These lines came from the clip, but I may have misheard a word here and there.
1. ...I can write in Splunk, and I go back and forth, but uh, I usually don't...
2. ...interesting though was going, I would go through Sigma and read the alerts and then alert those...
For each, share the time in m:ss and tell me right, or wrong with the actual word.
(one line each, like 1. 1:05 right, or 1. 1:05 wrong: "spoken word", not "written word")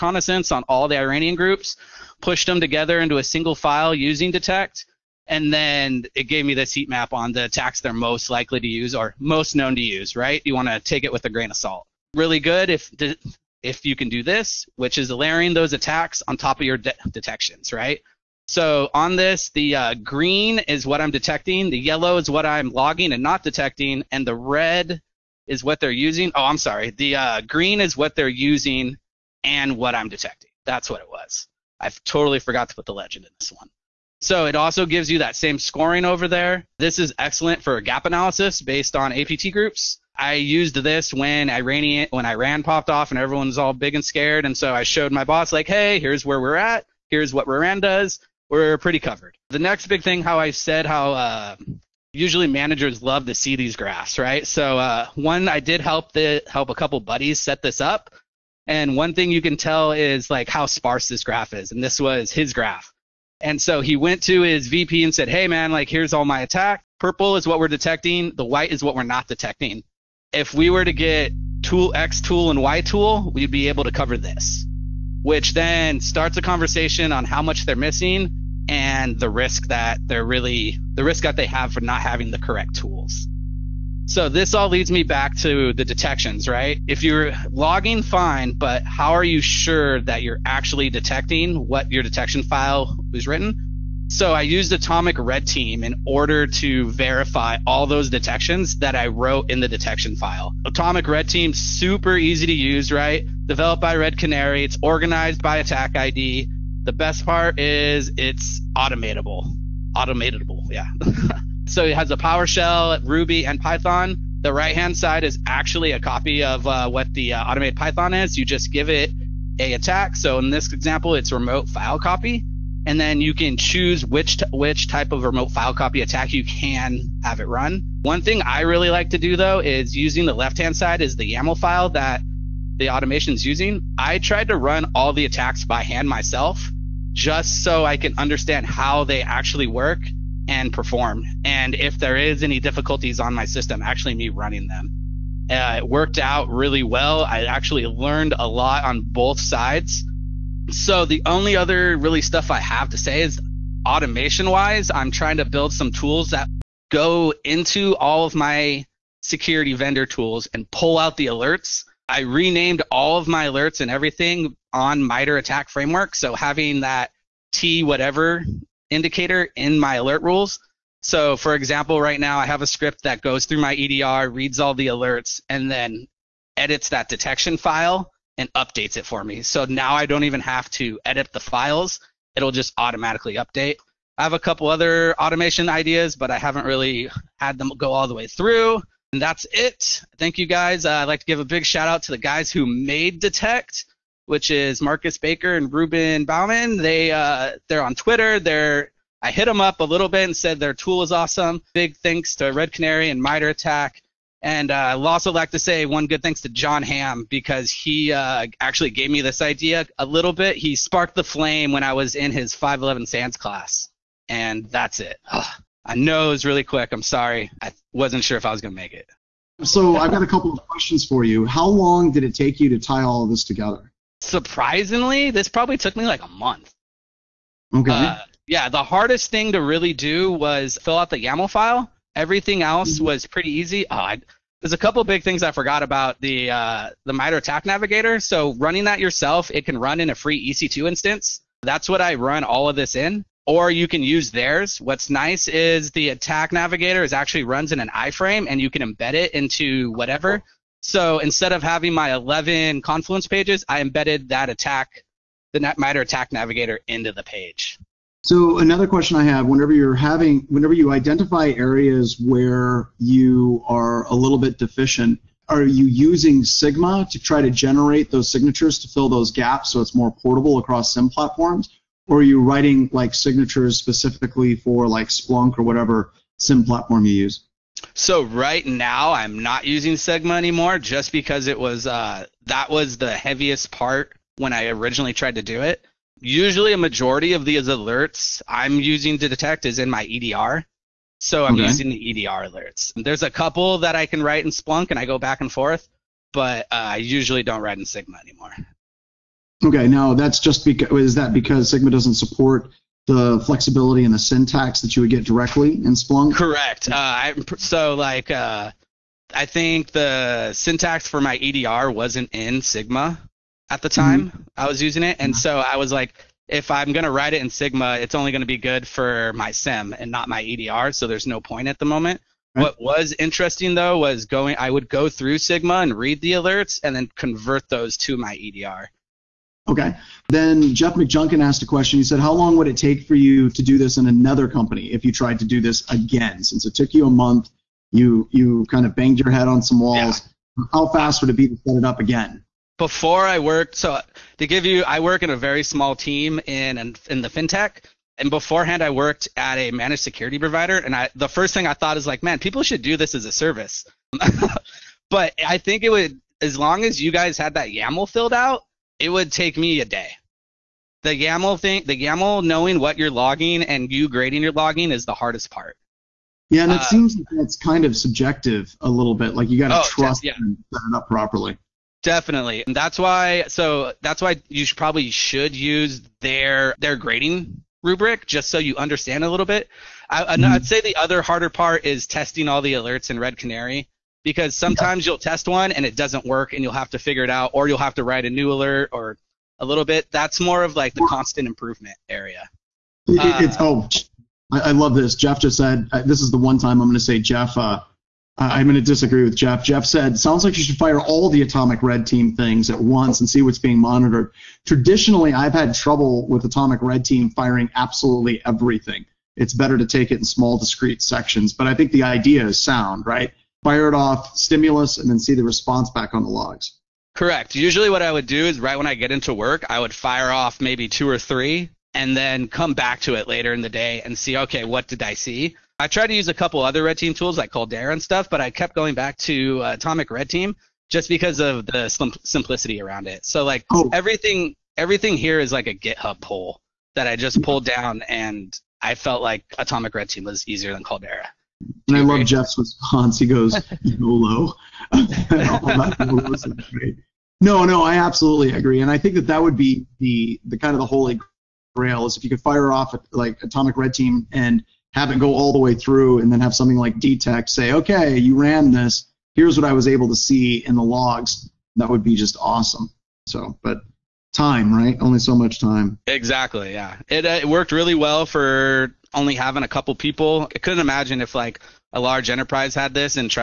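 1. 4:53 right
2. 5:23 wrong: "convert", not "alert".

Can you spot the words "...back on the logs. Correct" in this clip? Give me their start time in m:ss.
6:55.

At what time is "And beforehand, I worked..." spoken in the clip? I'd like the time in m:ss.
5:48.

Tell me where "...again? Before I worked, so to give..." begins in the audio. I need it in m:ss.
5:41.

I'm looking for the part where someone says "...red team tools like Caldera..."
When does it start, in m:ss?
7:06.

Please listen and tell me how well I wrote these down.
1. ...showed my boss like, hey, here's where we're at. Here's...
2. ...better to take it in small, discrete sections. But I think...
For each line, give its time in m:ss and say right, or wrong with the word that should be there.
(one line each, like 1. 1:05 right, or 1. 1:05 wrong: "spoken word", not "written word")
1. 0:44 right
2. 6:49 right.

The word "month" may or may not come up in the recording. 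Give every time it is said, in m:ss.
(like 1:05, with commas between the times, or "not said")
3:46, 5:37.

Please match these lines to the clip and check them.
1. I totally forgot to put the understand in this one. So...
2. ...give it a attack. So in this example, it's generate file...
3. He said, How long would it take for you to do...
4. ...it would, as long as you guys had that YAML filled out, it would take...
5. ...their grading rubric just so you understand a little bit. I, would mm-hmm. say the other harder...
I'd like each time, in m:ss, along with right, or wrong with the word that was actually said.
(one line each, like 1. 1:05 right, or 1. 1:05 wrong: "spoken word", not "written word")
1. 0:31 wrong: "legend", not "understand"
2. 1:58 wrong: "remote", not "generate"
3. 5:31 right
4. 5:55 right
5. 6:16 right.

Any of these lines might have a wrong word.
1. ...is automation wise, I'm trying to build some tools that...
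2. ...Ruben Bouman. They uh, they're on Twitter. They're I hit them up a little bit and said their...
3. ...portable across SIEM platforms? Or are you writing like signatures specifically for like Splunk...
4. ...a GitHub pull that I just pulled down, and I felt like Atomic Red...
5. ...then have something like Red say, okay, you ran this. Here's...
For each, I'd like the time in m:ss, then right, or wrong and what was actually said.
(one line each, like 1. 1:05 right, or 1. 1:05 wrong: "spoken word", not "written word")
1. 2:33 right
2. 3:15 right
3. 4:30 right
4. 7:15 right
5. 7:36 wrong: "DTEC", not "Red".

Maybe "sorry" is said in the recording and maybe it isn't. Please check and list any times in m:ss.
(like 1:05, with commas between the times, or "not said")
0:26, 3:37.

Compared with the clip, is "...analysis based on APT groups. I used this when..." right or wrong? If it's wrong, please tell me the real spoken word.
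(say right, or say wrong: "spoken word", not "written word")
right.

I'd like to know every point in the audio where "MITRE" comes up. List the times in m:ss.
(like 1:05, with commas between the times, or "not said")
2:45, 3:23, 3:57.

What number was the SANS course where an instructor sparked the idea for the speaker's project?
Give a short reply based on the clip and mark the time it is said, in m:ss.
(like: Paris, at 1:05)
511, at 3:32.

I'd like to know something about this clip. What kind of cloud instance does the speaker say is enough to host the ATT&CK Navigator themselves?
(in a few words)
Free EC2 instance.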